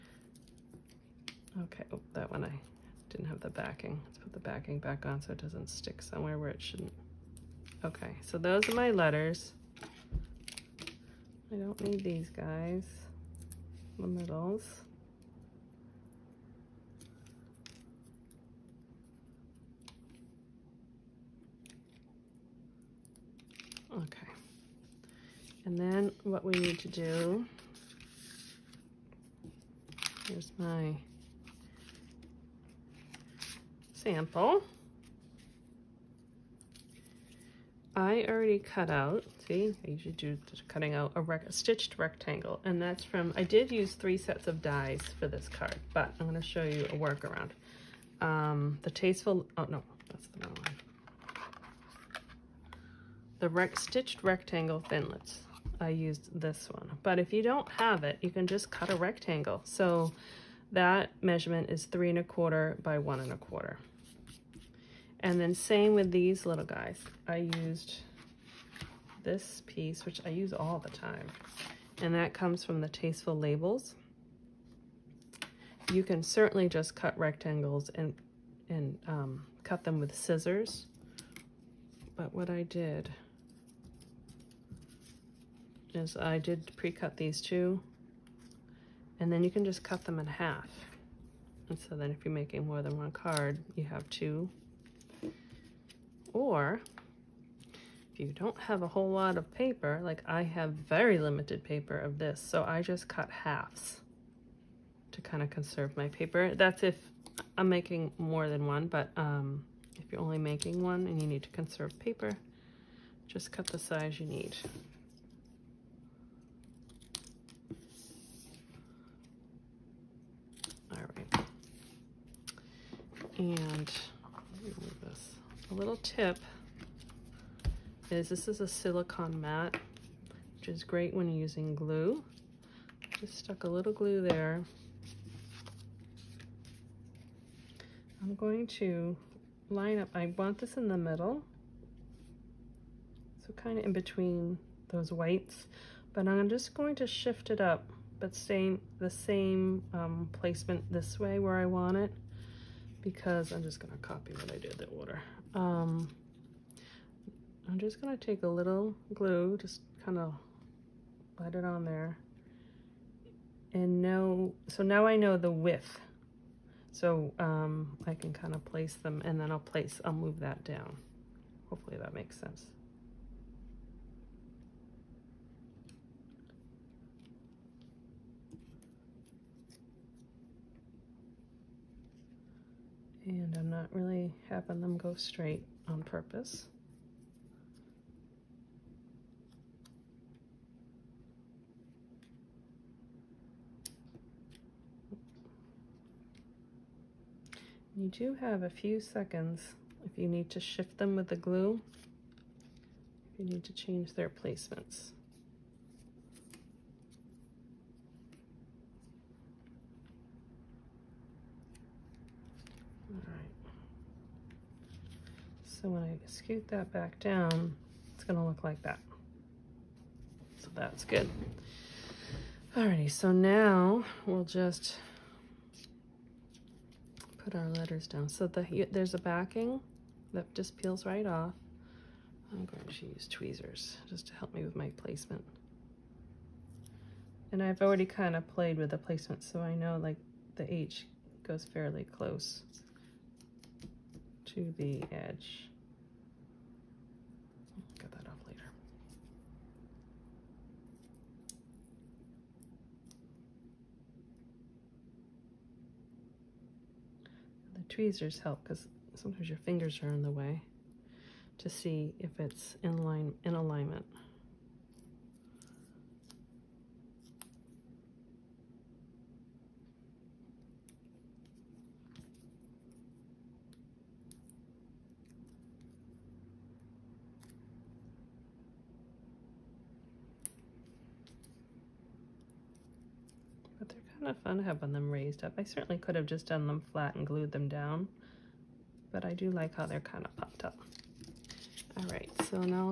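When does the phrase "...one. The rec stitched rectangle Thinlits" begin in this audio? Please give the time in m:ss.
0:50.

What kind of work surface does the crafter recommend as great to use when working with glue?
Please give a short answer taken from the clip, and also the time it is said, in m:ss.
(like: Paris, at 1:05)
silicone mat, at 2:08.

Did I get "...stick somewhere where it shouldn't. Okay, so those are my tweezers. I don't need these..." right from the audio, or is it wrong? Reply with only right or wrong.
wrong.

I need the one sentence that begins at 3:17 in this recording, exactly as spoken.
You do have a few seconds if you need to shift them with the glue, if you need to change their placements.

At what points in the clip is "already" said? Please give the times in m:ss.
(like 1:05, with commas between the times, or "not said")
0:38, 3:57.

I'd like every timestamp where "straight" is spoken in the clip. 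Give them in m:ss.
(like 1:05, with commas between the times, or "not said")
3:05.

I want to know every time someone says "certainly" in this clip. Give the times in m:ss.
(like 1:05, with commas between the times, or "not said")
1:16, 4:45.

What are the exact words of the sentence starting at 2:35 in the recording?
Um, I'm just gonna take a little glue, just kind of let it on there.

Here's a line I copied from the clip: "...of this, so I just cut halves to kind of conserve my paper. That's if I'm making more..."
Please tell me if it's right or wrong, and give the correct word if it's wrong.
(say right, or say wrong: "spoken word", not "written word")
right.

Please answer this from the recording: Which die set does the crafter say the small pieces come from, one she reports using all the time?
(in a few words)
Tasteful Labels.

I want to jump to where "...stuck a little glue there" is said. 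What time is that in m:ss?
2:13.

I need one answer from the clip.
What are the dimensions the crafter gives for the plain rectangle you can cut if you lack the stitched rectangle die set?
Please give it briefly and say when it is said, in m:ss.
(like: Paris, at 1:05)
3 1/4 by 1 1/4, at 1:01.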